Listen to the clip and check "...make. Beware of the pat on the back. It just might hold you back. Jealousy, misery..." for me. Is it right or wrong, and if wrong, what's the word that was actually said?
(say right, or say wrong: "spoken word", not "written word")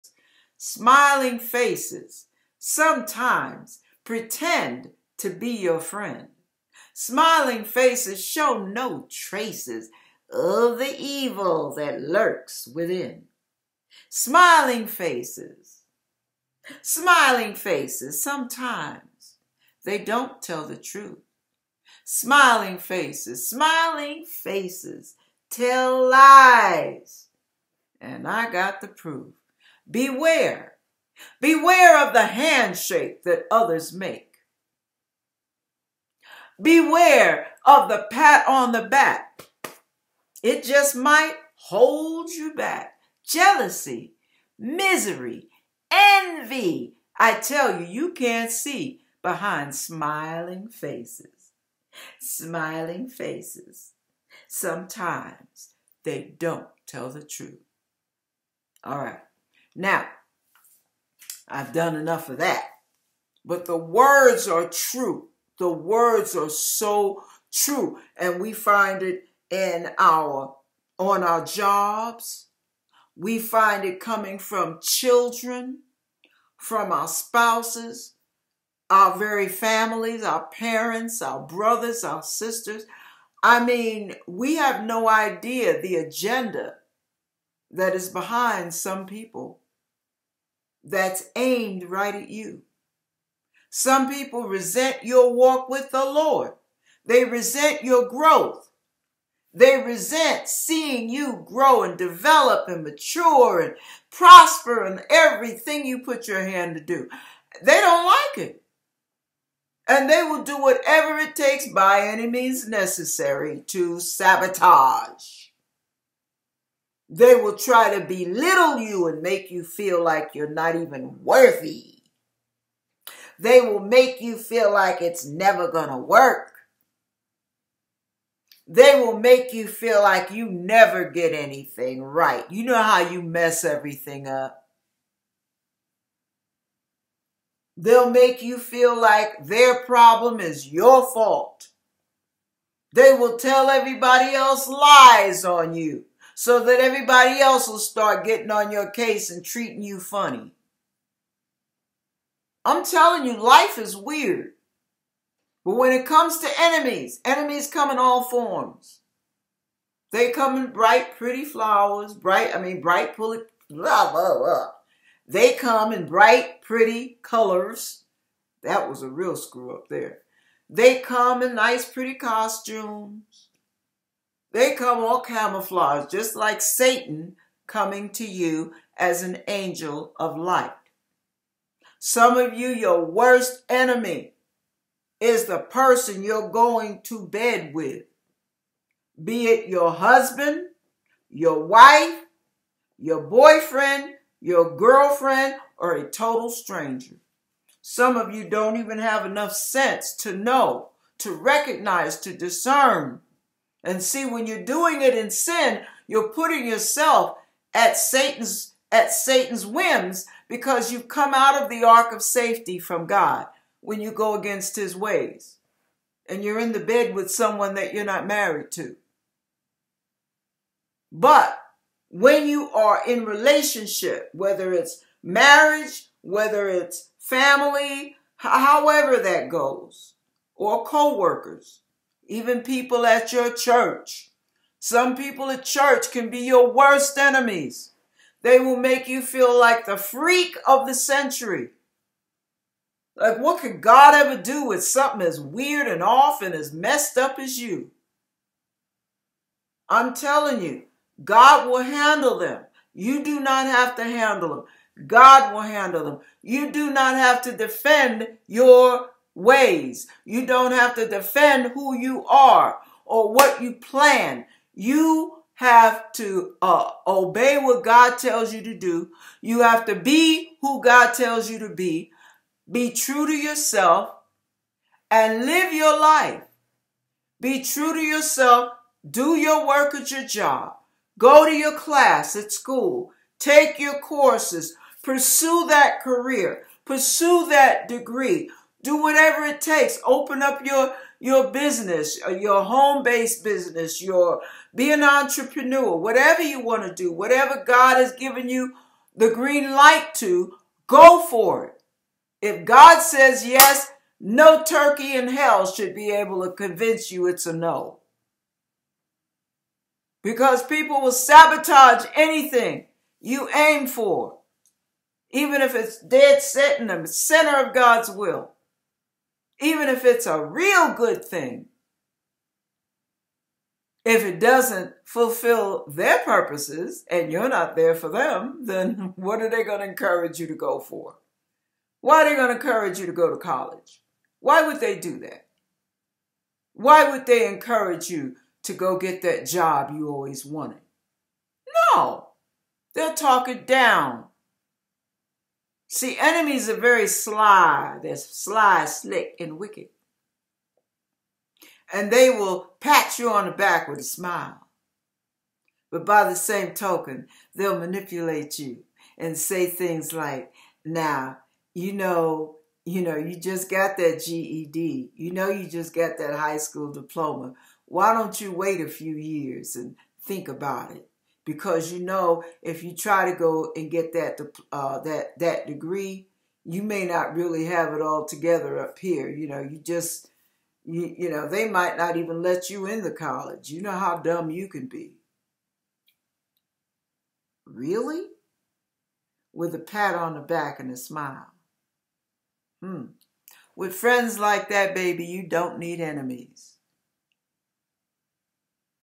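right.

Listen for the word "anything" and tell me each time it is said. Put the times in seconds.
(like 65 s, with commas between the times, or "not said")
131 s, 312 s.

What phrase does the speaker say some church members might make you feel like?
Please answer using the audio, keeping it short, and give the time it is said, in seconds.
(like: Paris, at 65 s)
freak of the century, at 239 s.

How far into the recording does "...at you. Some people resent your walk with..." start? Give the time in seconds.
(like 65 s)
92 s.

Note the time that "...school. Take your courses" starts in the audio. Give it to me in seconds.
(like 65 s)
282 s.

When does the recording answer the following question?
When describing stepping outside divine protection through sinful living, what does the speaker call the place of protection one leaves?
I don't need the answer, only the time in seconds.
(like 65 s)
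211 s.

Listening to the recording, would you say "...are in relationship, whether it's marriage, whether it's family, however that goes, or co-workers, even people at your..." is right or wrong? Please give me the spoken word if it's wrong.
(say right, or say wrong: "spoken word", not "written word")
right.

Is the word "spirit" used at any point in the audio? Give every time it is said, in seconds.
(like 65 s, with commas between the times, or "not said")
not said.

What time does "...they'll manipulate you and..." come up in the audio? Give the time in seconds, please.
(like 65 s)
357 s.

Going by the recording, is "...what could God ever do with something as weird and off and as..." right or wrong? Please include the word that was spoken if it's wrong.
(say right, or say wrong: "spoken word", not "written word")
right.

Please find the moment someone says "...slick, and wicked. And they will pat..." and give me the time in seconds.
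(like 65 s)
348 s.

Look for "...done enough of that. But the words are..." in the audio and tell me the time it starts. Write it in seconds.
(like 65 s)
61 s.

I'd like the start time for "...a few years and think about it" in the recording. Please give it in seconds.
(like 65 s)
368 s.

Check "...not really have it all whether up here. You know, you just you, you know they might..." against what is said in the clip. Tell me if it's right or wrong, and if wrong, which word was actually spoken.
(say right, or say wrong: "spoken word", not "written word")
wrong: "together", not "whether".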